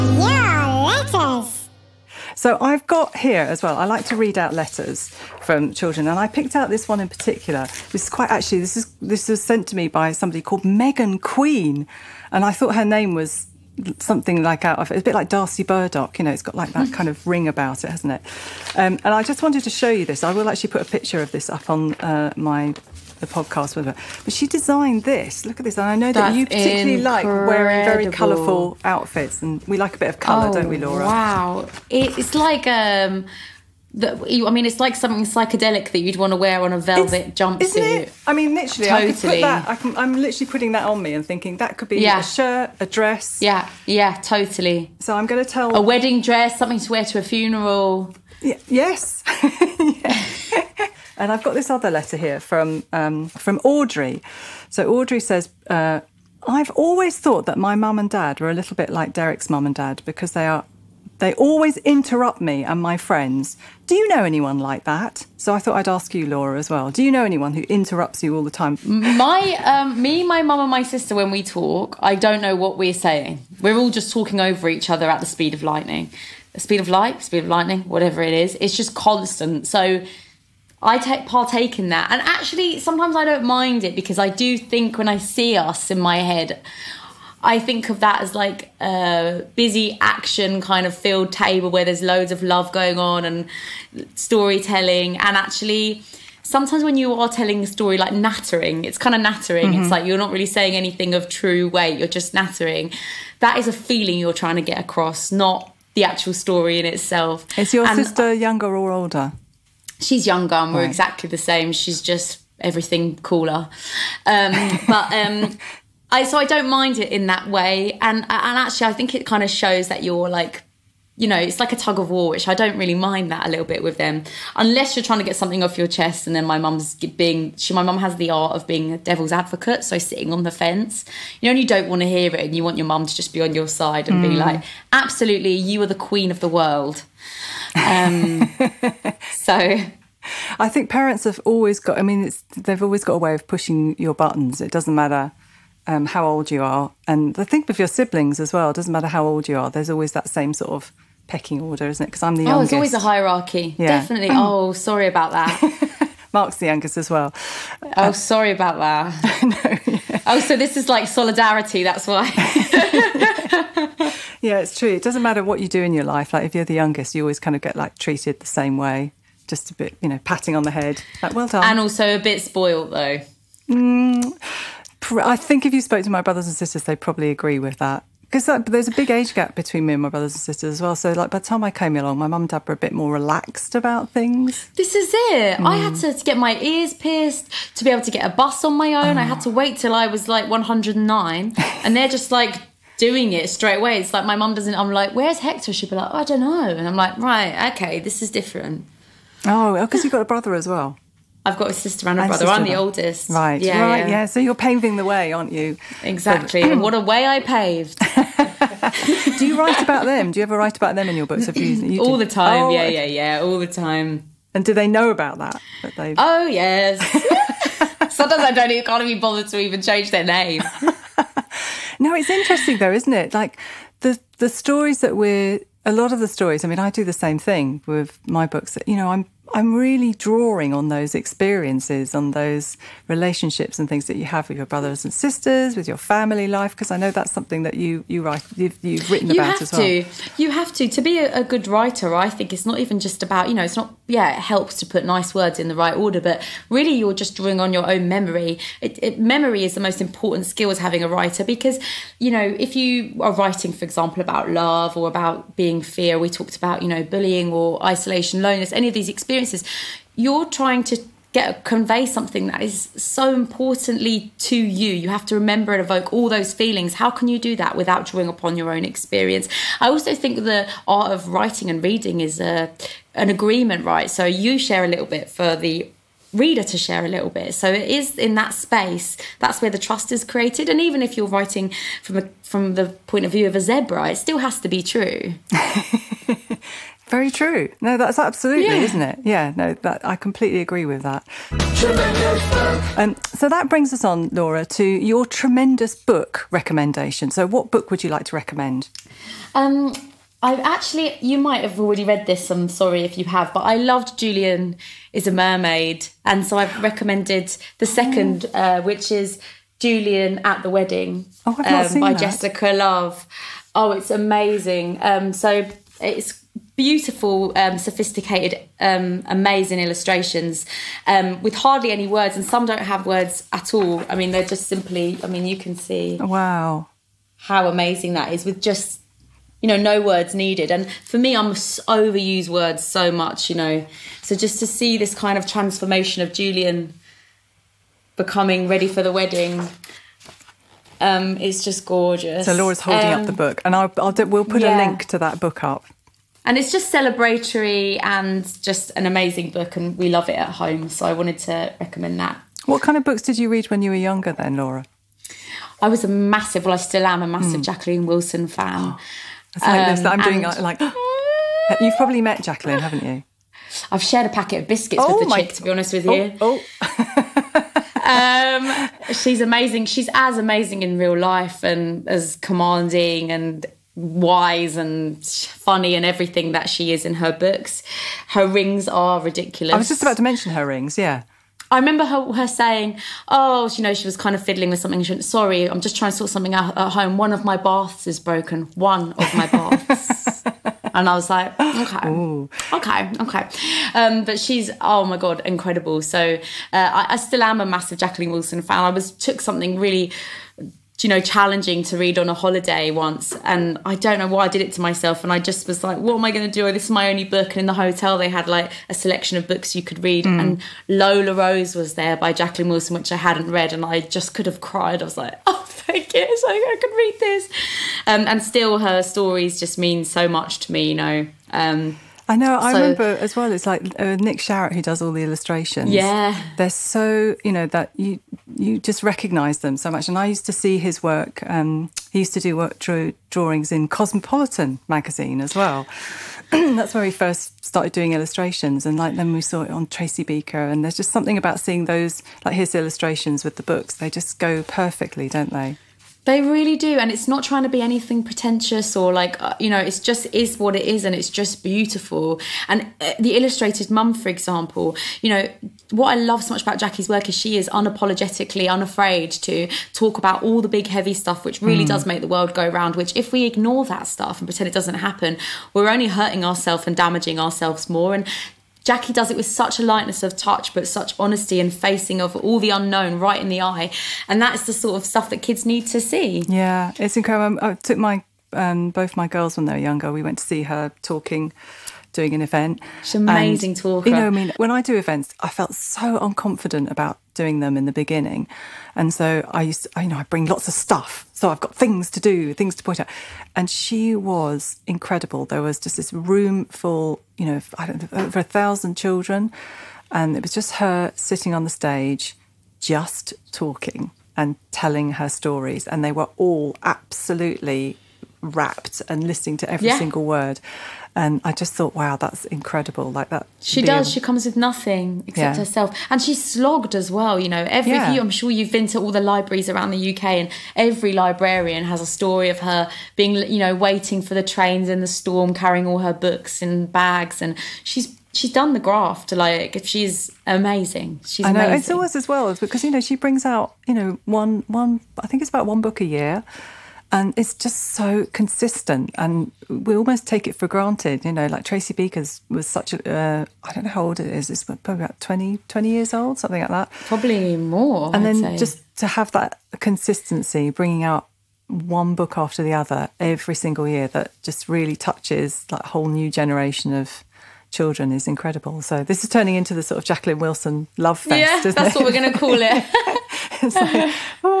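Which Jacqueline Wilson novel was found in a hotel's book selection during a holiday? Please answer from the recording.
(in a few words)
Lola Rose.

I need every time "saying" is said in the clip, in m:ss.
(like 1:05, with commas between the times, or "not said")
1:12, 1:40, 6:22.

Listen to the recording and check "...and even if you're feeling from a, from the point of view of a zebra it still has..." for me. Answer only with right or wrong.
wrong.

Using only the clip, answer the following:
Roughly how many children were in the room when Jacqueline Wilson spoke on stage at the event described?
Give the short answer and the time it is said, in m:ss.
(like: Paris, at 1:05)
over 1,000, at 8:18.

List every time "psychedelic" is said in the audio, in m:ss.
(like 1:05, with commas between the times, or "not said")
0:35.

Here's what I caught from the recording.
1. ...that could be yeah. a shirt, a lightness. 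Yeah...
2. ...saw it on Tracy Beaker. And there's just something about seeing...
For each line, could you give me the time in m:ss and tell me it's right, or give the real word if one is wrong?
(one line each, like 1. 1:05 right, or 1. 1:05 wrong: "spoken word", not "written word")
1. 0:41 wrong: "dress", not "lightness"
2. 7:19 right.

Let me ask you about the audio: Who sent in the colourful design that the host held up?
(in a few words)
Megan Queen.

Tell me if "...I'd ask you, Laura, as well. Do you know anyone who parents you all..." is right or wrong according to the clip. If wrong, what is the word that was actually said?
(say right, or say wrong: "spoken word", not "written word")
wrong: "interrupts", not "parents".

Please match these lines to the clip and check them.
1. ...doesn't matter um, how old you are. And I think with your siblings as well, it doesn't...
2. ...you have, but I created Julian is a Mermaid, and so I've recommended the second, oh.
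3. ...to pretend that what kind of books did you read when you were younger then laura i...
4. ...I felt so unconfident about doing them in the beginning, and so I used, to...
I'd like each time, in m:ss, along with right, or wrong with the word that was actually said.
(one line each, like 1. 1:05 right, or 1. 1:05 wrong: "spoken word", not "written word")
1. 2:24 right
2. 5:03 wrong: "loved", not "created"
3. 5:51 wrong: "recommend", not "pretend"
4. 8:05 right.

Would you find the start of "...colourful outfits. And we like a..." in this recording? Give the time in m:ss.
0:28.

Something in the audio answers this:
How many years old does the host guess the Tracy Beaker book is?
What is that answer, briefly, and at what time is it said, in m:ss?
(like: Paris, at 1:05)
20, at 9:05.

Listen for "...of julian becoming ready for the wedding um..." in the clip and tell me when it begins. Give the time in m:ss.
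5:36.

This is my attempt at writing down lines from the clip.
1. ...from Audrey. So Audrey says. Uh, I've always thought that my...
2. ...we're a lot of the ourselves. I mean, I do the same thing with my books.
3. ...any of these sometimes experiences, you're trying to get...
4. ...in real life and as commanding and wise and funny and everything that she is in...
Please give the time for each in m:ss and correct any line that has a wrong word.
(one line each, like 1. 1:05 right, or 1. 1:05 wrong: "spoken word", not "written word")
1. 0:53 right
2. 3:45 wrong: "stories", not "ourselves"
3. 4:18 wrong: "experiences", not "sometimes"
4. 6:10 right.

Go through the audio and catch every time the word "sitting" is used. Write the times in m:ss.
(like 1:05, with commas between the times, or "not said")
2:09, 8:21.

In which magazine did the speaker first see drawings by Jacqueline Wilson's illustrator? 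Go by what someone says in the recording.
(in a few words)
Cosmopolitan.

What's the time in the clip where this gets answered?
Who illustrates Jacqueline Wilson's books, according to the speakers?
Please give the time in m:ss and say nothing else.
7:04.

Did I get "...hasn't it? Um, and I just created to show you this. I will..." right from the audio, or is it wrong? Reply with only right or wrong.
wrong.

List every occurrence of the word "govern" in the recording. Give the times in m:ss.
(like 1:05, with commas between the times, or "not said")
not said.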